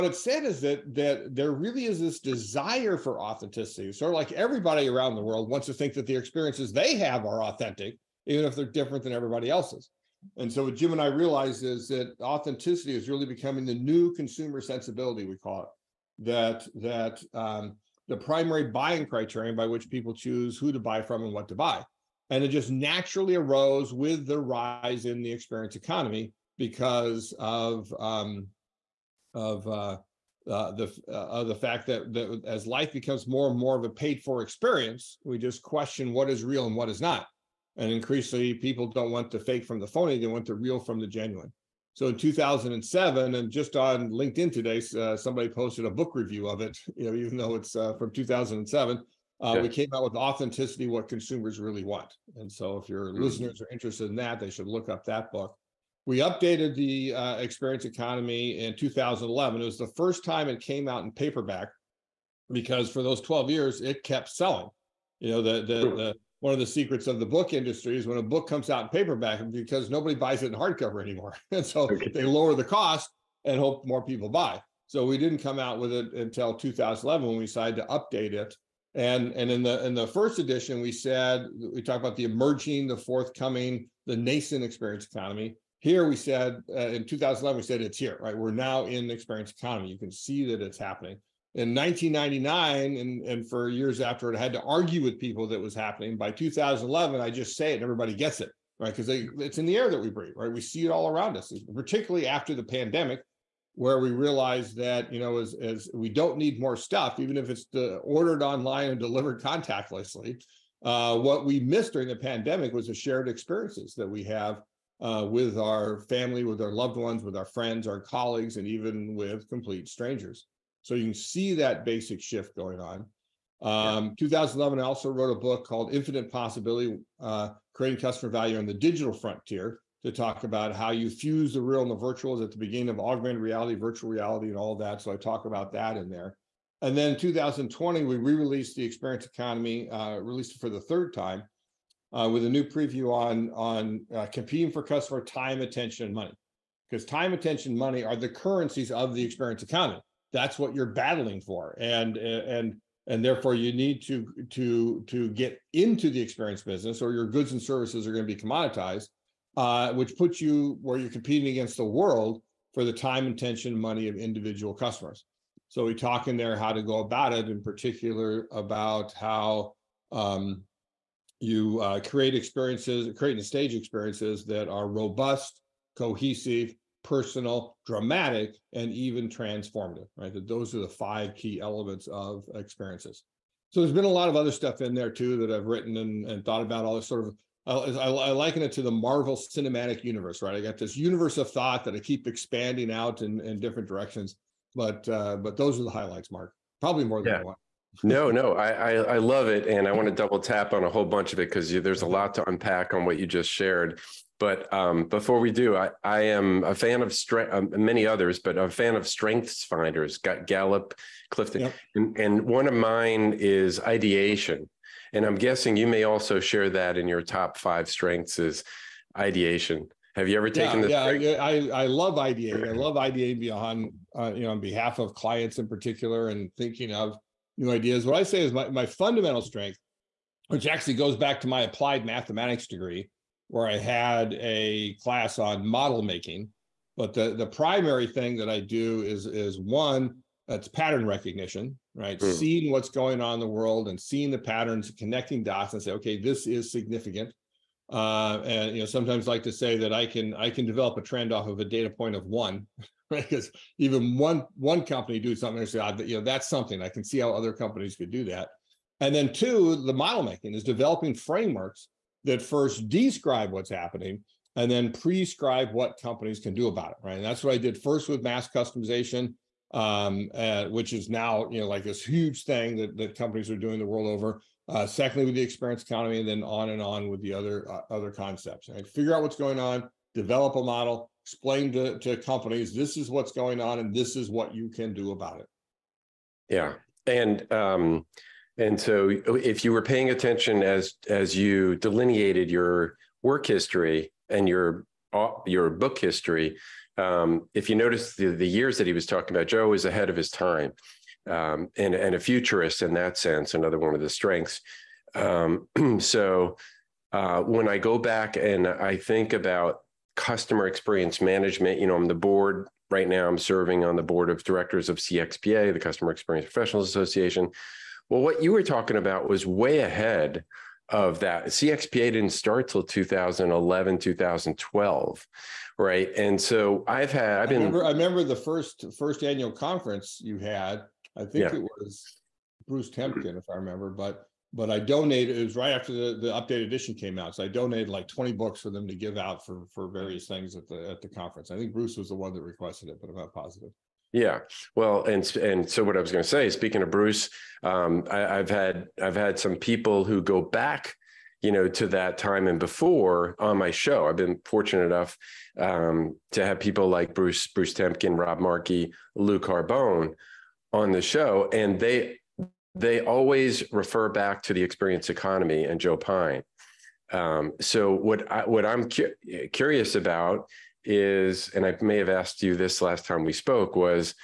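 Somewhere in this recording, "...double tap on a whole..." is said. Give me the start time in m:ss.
3:20.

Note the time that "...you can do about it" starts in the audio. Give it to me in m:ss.
4:44.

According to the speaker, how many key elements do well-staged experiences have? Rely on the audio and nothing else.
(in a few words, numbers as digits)
5.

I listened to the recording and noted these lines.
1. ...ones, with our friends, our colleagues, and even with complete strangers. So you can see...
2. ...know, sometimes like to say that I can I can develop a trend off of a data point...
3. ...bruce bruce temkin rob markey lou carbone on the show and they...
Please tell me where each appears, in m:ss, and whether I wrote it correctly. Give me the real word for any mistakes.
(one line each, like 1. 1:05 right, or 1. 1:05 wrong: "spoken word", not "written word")
1. 1:56 right
2. 4:08 right
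3. 5:57 right.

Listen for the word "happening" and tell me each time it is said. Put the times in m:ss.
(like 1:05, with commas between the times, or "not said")
1:30, 1:35, 4:23.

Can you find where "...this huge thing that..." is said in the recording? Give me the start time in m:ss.
4:31.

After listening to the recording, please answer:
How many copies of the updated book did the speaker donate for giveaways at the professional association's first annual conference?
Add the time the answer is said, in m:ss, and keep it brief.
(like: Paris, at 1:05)
20, at 5:38.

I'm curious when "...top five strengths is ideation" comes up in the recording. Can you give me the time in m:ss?
3:37.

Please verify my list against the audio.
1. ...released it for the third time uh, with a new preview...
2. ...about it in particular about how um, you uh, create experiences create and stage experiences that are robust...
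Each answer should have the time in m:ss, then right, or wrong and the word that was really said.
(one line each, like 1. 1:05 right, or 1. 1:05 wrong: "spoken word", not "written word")
1. 2:20 right
2. 2:46 right.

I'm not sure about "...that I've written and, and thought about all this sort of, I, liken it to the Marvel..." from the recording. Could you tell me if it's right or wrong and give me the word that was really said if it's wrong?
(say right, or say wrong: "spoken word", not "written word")
right.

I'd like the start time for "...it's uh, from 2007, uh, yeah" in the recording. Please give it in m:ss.
0:47.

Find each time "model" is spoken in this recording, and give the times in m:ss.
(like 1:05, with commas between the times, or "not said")
3:55, 4:19, 4:40.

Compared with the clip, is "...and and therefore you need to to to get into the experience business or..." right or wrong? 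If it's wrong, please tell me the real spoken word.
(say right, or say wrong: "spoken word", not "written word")
right.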